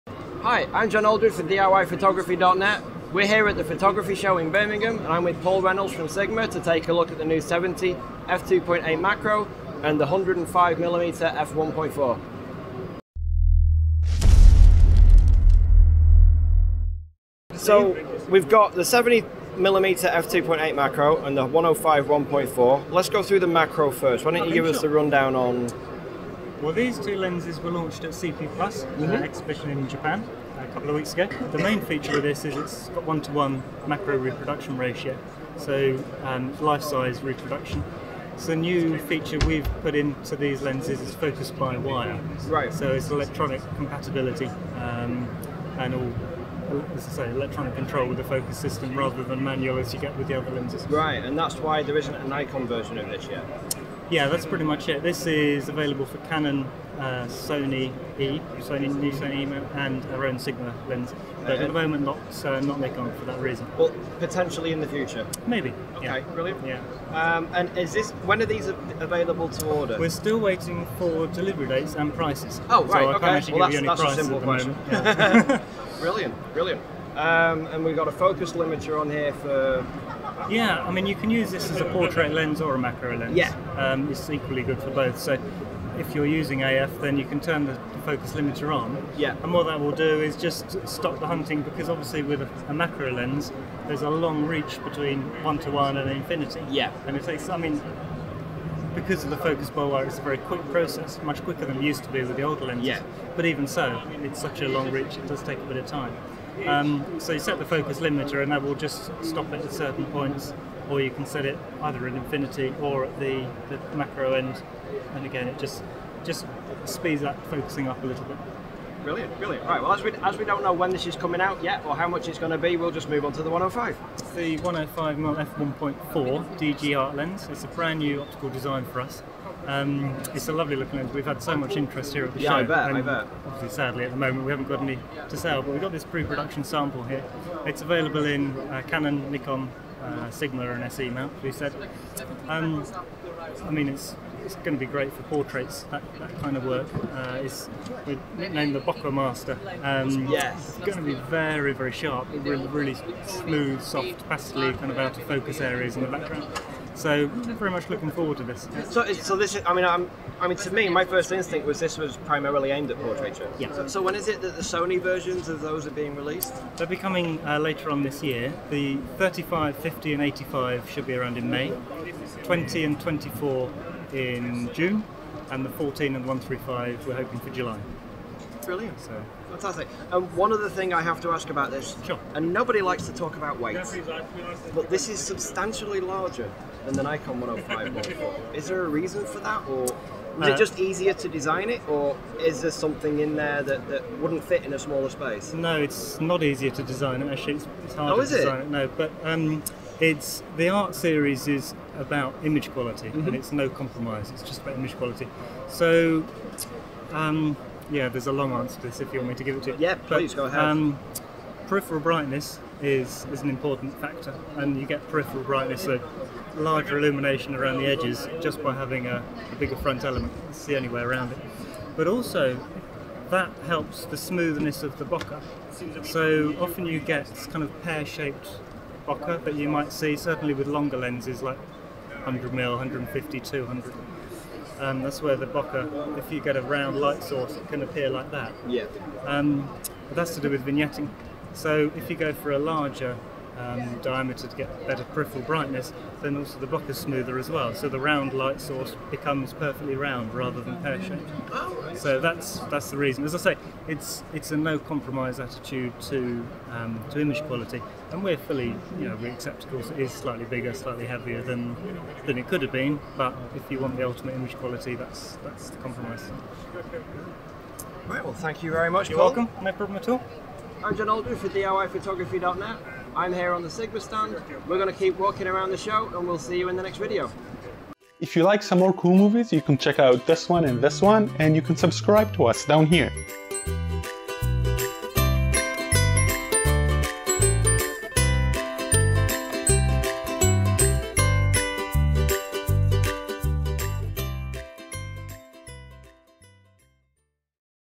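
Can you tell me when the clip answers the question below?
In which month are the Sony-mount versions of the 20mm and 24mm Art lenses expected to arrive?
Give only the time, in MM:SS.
02:54.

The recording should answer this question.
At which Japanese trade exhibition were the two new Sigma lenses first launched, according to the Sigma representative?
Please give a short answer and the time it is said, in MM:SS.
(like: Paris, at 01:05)
CP Plus, at 00:28.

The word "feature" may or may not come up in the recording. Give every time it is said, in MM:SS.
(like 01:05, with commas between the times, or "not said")
00:31, 00:39.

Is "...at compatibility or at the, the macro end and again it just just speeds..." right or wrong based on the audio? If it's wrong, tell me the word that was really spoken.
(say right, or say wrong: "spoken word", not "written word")
wrong: "infinity", not "compatibility".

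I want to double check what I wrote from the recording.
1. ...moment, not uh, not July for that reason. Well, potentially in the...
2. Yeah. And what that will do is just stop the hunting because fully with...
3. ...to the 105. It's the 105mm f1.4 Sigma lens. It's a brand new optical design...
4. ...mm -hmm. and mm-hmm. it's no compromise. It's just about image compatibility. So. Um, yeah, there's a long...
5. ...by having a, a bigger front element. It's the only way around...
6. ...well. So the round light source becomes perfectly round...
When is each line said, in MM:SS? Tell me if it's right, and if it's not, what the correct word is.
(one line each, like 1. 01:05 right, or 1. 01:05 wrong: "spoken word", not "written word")
1. 01:01 wrong: "Nikon", not "July"
2. 01:29 wrong: "obviously", not "fully"
3. 02:03 wrong: "DGR", not "Sigma"
4. 03:23 wrong: "quality", not "compatibility"
5. 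03:38 right
6. 04:07 right.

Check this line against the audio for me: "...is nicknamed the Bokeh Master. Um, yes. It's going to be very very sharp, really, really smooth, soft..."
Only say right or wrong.
right.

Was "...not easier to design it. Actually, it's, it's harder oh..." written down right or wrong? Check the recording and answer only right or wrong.
right.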